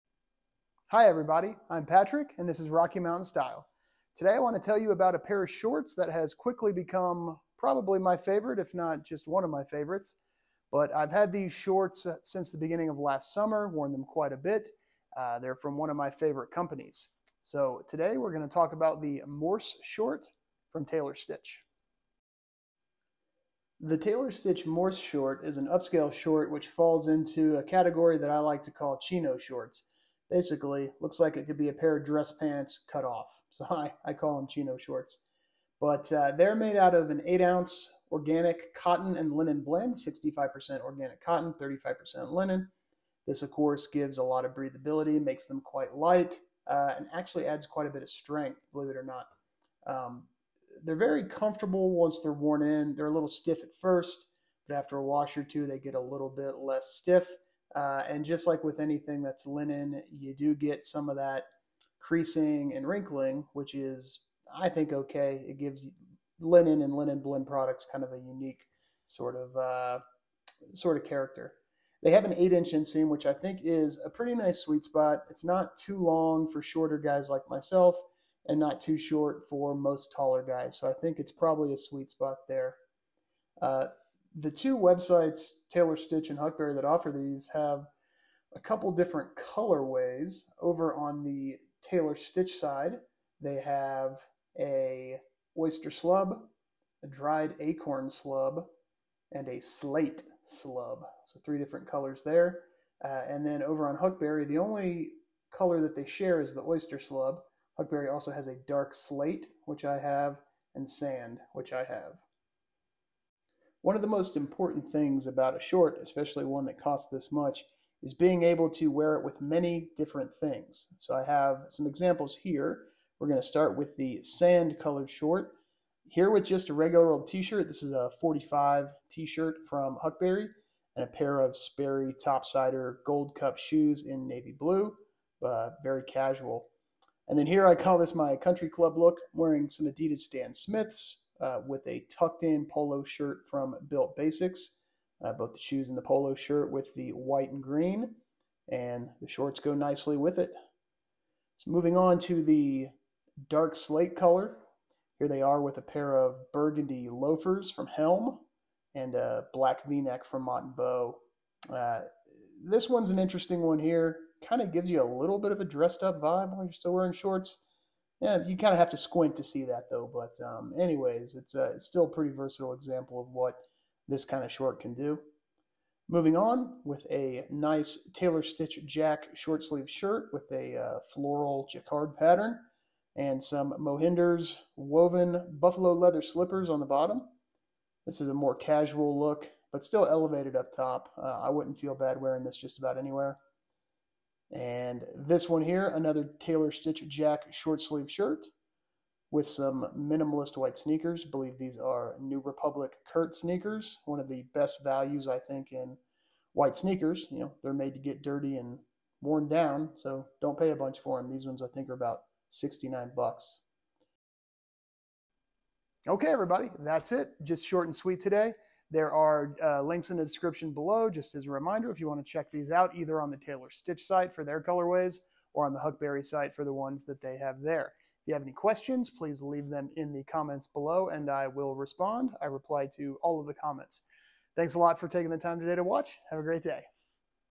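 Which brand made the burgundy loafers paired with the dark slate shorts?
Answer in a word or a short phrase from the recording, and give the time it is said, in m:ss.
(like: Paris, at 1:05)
Helm, at 2:37.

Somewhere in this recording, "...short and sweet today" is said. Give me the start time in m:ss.
3:37.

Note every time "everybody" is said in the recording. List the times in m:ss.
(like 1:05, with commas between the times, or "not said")
0:01, 3:36.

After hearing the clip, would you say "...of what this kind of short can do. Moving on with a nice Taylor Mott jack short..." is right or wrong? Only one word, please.
wrong.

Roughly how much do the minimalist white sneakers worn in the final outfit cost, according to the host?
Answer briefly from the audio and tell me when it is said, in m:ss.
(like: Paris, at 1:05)
$69, at 3:32.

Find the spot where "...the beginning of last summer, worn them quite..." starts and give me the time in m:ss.
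0:12.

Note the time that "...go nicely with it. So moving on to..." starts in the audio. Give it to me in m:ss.
2:29.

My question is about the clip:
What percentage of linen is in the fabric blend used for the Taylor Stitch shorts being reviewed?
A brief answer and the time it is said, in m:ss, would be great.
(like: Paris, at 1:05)
35%, at 0:41.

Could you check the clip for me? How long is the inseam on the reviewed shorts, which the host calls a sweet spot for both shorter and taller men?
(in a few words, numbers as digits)
8 inches.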